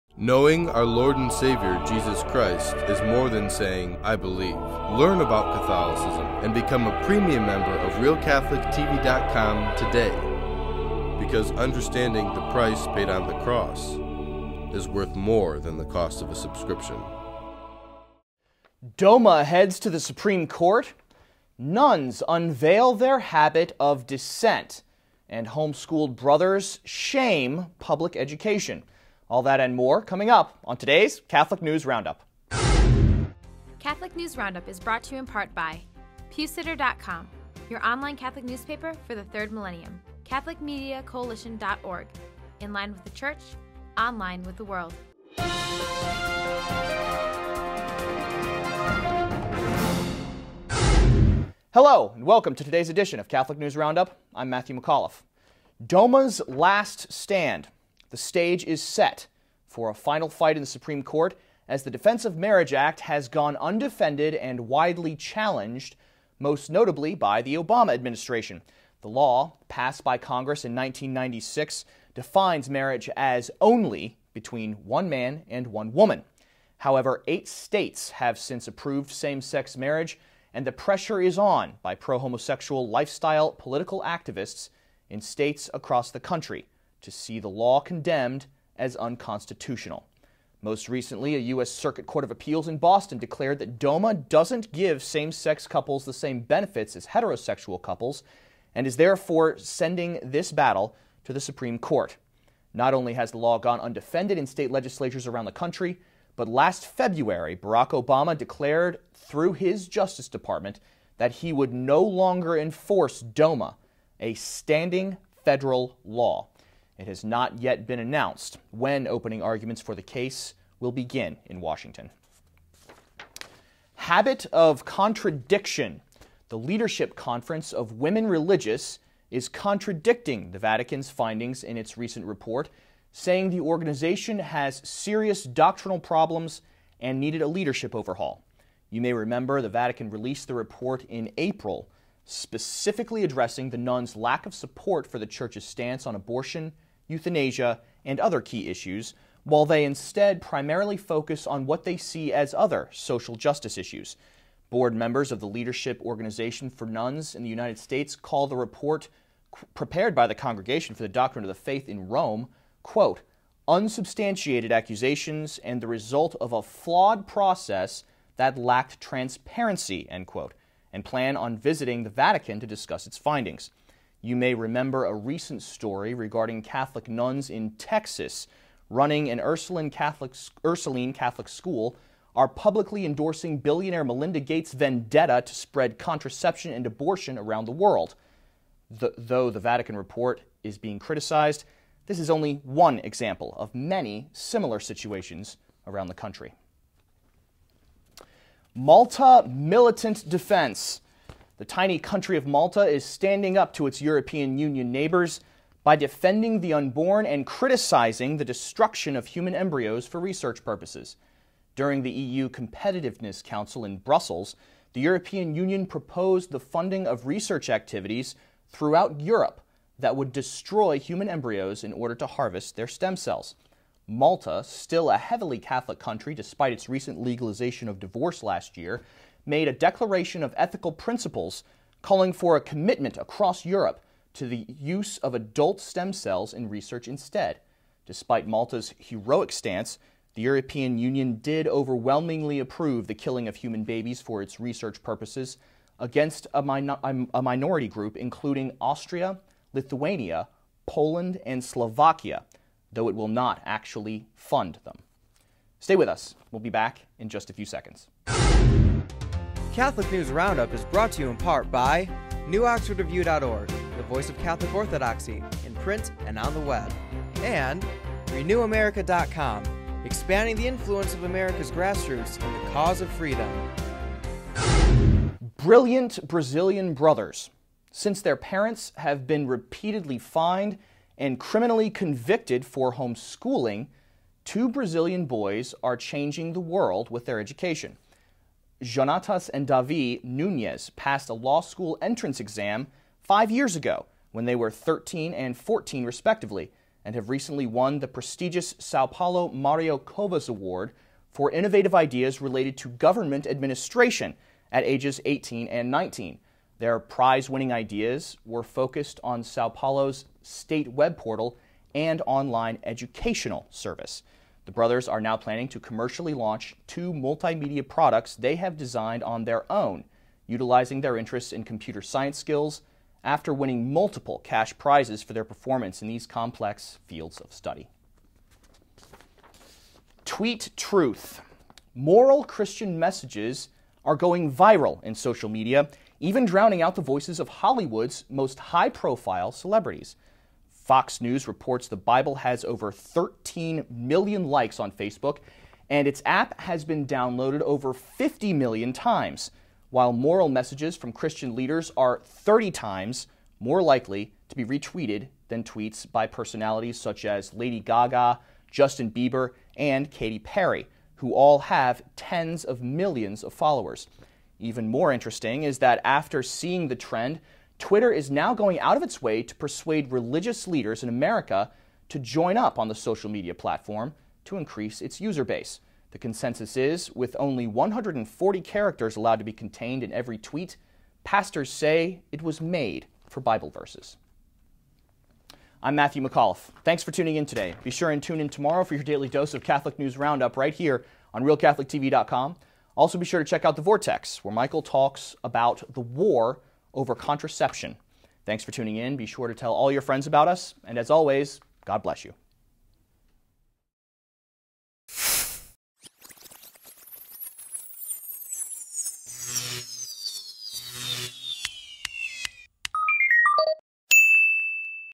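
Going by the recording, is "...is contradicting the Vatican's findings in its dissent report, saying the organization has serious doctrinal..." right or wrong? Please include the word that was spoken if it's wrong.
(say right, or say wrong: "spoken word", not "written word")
wrong: "recent", not "dissent".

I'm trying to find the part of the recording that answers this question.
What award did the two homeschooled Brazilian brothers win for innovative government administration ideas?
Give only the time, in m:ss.
4:58.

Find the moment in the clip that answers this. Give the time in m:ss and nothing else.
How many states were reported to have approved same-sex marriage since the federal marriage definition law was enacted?
1:17.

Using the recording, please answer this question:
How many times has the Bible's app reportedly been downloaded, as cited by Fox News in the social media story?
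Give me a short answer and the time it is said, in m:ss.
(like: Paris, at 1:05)
Over 50 million, at 5:47.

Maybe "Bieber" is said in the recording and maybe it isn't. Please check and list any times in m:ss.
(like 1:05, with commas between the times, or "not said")
5:59.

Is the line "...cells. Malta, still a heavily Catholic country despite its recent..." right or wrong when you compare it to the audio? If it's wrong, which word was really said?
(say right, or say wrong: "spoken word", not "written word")
right.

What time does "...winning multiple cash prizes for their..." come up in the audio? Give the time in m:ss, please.
5:23.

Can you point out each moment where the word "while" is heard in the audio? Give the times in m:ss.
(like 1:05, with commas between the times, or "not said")
2:29, 5:49.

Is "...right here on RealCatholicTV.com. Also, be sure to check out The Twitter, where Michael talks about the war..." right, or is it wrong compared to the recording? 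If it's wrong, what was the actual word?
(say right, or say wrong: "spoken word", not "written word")
wrong: "Vortex", not "Twitter".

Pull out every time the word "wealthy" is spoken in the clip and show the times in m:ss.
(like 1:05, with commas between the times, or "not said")
not said.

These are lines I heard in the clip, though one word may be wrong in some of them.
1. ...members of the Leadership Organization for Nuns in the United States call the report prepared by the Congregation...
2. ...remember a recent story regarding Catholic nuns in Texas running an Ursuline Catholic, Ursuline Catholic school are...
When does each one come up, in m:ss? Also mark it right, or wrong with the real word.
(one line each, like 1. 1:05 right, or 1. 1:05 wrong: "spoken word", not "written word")
1. 2:34 right
2. 2:54 right.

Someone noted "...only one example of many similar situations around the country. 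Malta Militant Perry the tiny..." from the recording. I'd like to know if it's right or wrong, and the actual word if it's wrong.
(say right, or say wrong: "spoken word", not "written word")
wrong: "Defense", not "Perry".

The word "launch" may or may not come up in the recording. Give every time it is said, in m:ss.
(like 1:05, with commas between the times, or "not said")
5:16.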